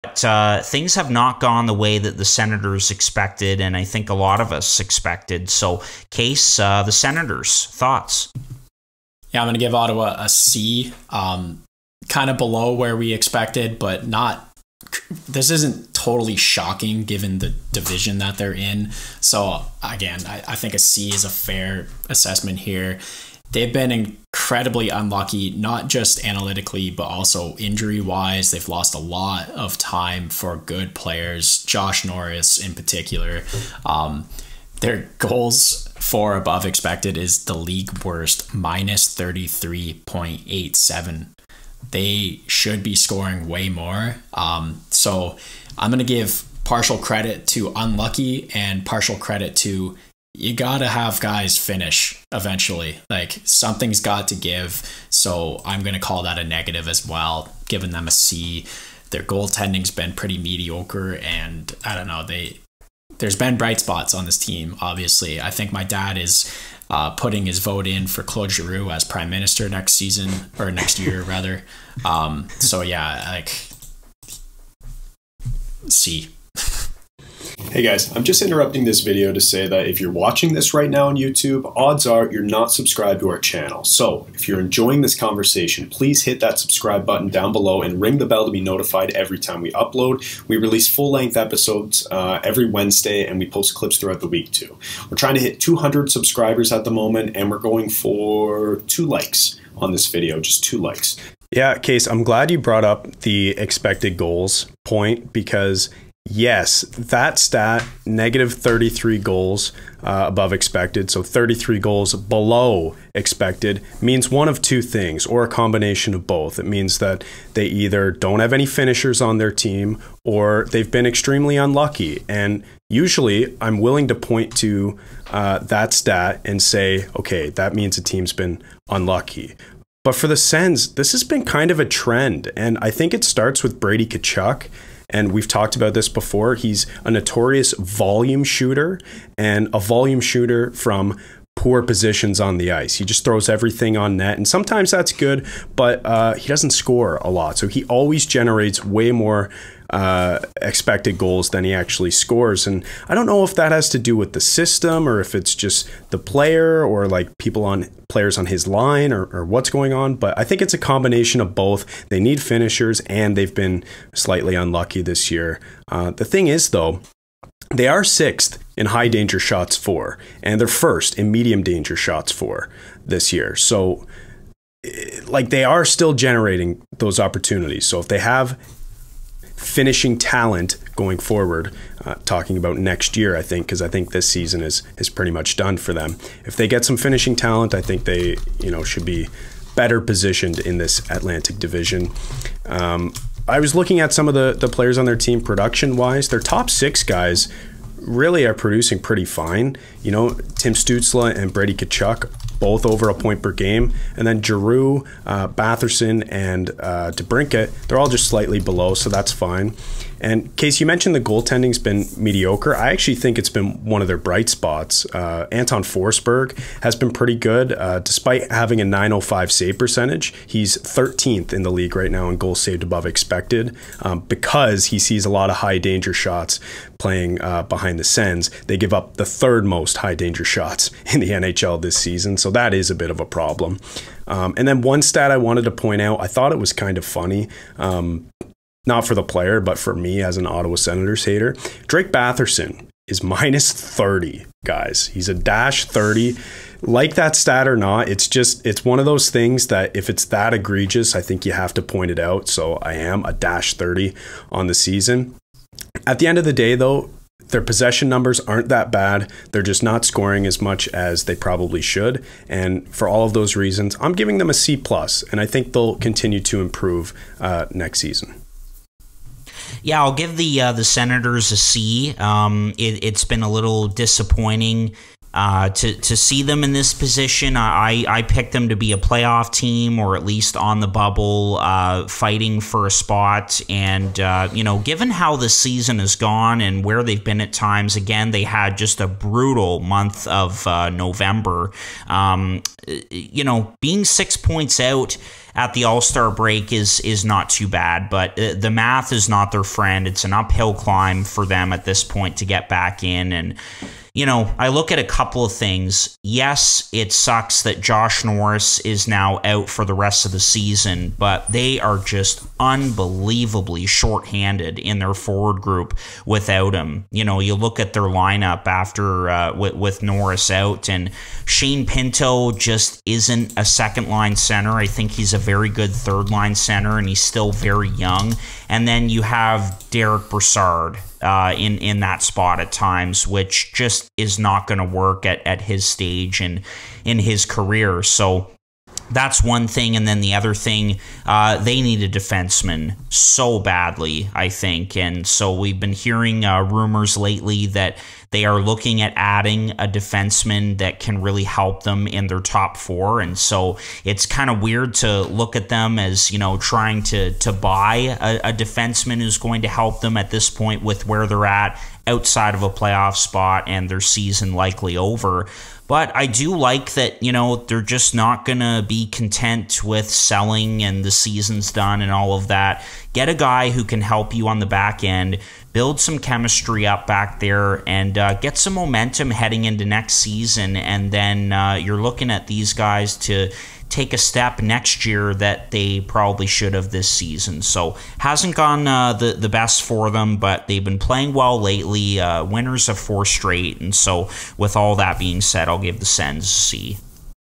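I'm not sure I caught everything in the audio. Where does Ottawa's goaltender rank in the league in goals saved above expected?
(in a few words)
13th.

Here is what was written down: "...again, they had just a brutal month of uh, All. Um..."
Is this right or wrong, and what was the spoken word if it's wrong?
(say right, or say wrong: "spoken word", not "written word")
wrong: "November", not "All".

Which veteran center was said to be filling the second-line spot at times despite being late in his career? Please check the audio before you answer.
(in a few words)
Derick Brassard.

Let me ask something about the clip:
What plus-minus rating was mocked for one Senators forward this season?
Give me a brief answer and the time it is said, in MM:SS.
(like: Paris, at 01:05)
-30, at 04:03.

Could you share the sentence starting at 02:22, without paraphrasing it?
He just throws everything on net, and sometimes that's good, but uh, he doesn't score a lot.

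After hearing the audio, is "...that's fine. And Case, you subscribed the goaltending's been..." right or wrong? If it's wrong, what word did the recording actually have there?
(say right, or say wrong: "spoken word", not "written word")
wrong: "mentioned", not "subscribed".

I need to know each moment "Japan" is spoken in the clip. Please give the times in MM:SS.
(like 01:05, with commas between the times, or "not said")
not said.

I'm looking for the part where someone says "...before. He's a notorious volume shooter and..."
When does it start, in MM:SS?
02:16.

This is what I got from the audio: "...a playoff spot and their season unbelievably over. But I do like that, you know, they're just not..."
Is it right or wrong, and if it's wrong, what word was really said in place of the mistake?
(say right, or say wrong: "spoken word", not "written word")
wrong: "likely", not "unbelievably".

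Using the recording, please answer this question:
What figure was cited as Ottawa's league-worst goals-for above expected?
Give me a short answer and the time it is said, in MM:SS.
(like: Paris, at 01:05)
-33.87, at 00:38.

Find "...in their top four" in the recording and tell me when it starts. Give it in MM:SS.
05:52.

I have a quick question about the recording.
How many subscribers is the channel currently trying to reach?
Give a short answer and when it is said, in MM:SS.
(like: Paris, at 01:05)
200, at 01:35.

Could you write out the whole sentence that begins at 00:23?
They've been in incredibly unlucky, not just analytically, but also injury wise.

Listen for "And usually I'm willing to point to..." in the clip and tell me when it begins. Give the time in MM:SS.
02:02.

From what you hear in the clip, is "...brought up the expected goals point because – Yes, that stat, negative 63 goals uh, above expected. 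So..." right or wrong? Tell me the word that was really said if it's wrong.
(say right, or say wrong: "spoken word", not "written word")
wrong: "33", not "63".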